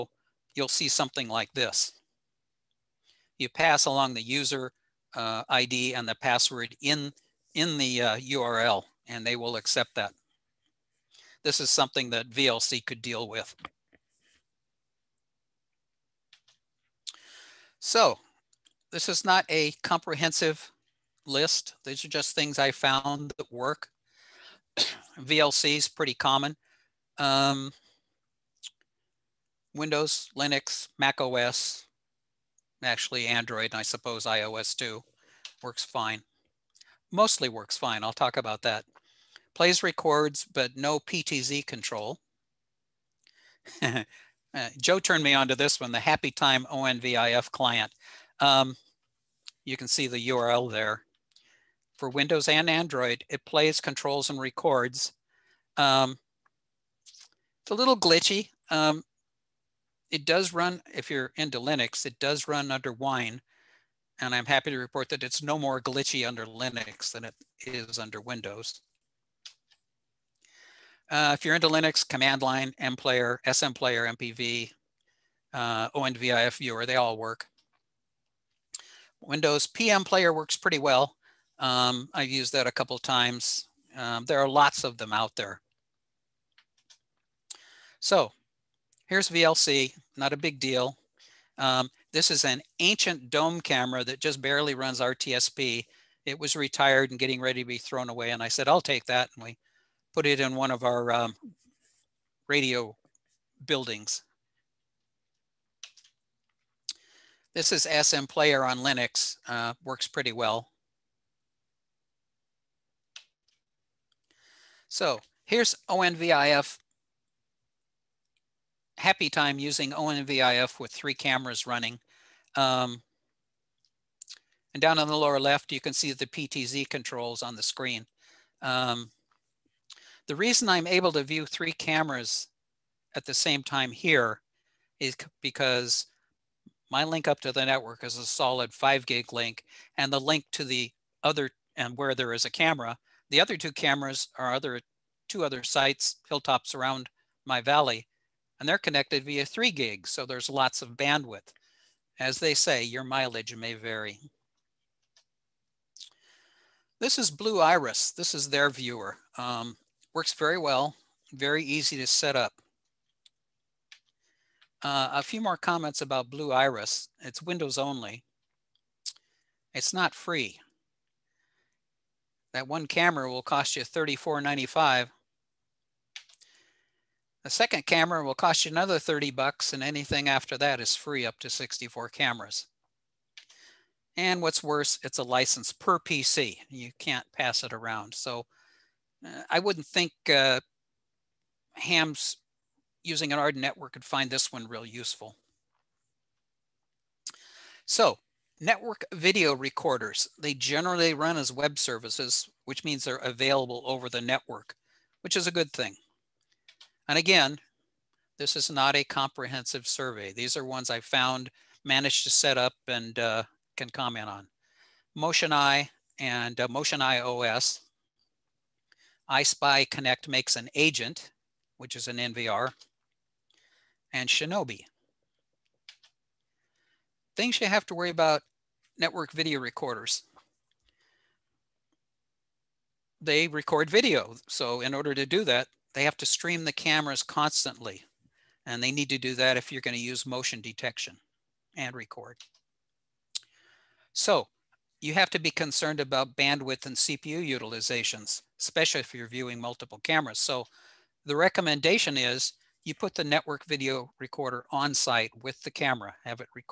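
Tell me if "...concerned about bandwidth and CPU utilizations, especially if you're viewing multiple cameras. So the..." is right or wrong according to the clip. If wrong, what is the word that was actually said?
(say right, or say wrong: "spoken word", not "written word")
right.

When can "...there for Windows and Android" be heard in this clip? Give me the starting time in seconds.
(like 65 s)
50 s.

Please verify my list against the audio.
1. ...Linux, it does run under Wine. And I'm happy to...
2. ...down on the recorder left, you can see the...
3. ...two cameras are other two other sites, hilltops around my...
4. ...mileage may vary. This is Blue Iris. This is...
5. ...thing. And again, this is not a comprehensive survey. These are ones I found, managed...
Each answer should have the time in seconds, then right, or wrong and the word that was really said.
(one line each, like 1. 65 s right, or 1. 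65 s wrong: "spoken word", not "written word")
1. 61 s right
2. 124 s wrong: "lower", not "recorder"
3. 143 s right
4. 153 s right
5. 205 s right.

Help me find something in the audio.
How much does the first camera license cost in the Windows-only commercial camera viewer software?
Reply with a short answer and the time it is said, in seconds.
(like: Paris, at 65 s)
$34.95, at 173 s.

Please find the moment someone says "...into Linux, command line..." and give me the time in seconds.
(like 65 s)
71 s.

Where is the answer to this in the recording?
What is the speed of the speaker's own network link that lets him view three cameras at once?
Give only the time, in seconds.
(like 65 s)
138 s.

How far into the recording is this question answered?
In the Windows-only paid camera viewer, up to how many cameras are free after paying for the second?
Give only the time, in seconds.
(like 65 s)
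181 s.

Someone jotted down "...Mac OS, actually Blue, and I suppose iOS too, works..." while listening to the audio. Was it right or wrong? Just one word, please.
wrong.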